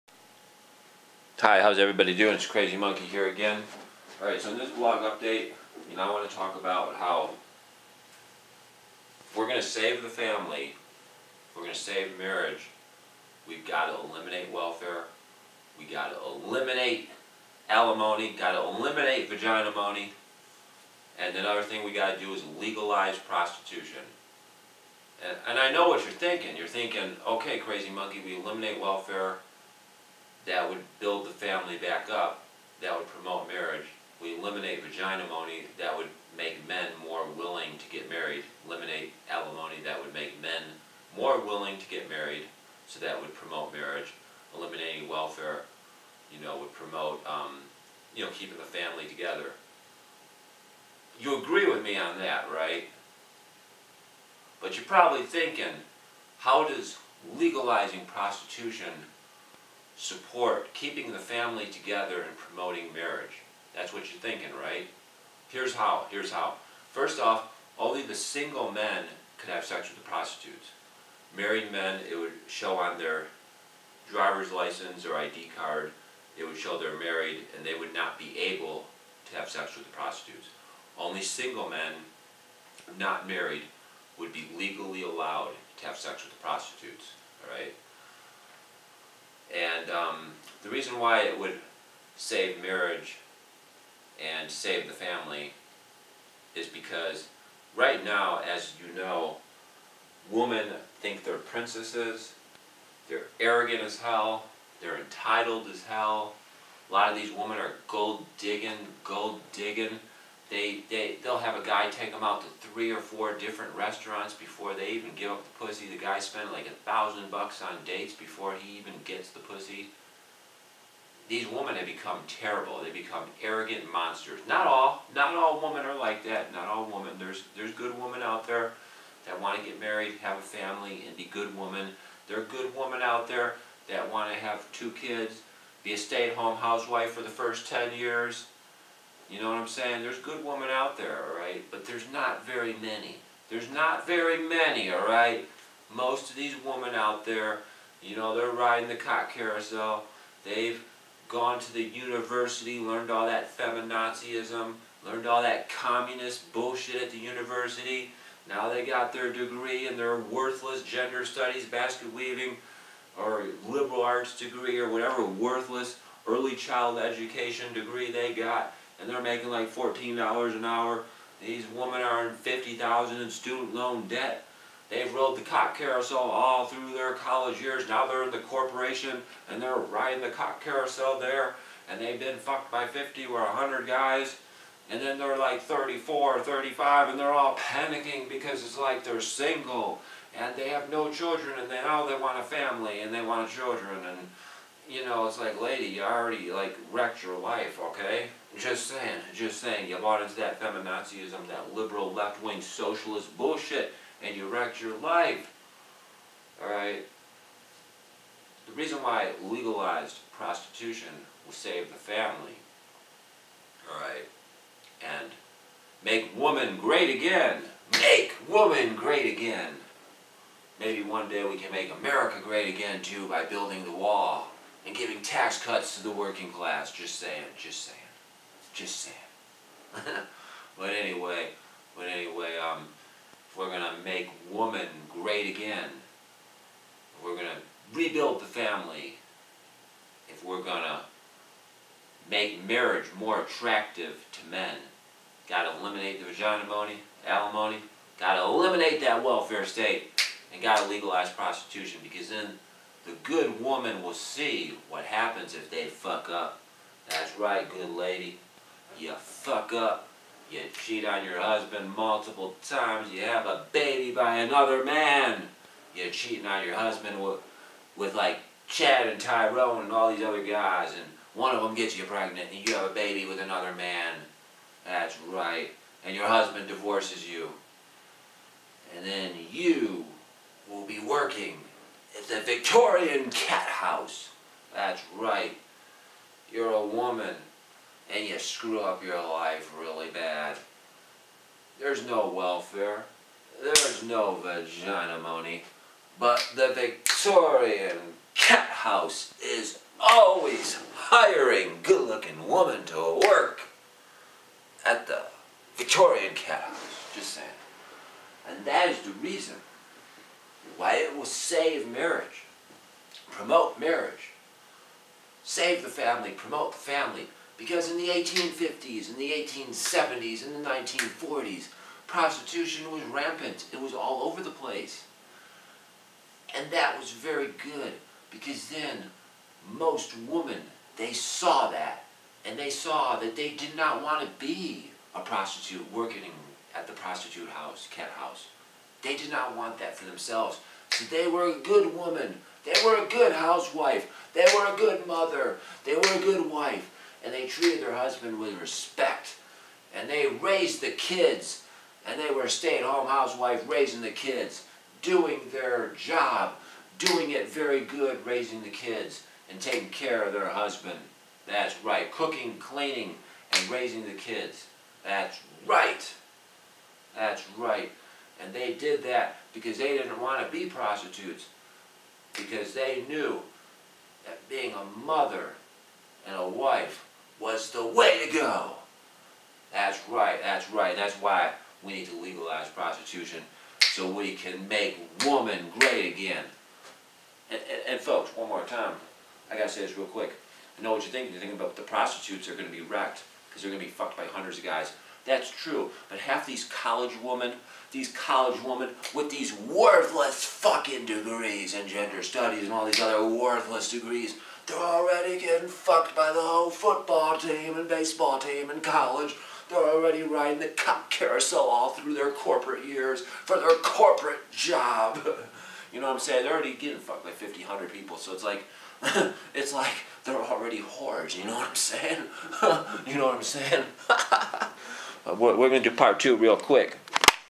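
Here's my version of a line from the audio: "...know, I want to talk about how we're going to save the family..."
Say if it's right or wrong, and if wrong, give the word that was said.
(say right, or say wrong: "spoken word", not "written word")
right.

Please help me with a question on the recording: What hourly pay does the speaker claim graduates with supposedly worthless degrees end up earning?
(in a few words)
$14 an hour.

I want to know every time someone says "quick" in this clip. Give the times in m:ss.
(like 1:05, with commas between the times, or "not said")
6:30, 7:06.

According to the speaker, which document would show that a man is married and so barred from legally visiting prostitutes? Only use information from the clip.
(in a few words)
driver's license.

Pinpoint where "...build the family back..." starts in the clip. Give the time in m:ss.
0:30.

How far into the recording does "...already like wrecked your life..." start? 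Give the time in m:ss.
3:16.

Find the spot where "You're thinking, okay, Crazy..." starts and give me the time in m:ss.
0:26.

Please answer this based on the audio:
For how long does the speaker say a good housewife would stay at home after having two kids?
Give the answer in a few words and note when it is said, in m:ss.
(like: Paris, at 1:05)
first 10 years, at 2:17.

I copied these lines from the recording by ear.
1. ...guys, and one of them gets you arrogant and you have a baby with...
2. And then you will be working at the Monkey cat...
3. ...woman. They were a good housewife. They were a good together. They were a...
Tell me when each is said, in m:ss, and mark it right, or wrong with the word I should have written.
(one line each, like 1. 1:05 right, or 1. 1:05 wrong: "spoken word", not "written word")
1. 4:30 wrong: "pregnant", not "arrogant"
2. 4:38 wrong: "Victorian", not "Monkey"
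3. 5:41 wrong: "mother", not "together".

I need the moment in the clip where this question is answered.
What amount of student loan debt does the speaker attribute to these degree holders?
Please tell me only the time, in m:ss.
2:52.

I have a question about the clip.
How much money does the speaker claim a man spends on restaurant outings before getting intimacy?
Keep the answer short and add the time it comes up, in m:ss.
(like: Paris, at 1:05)
$1,000, at 1:56.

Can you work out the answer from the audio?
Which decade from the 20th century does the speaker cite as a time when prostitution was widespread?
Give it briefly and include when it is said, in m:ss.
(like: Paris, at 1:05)
1940s, at 5:20.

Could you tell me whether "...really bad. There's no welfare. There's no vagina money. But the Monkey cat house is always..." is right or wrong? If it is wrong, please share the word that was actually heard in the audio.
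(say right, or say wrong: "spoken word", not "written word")
wrong: "Victorian", not "Monkey".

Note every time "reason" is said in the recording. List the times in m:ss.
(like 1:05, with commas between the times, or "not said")
1:30, 3:28, 5:09.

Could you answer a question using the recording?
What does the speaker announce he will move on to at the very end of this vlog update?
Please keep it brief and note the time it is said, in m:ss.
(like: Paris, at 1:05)
part two, at 7:05.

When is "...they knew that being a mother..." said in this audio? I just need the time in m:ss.
6:12.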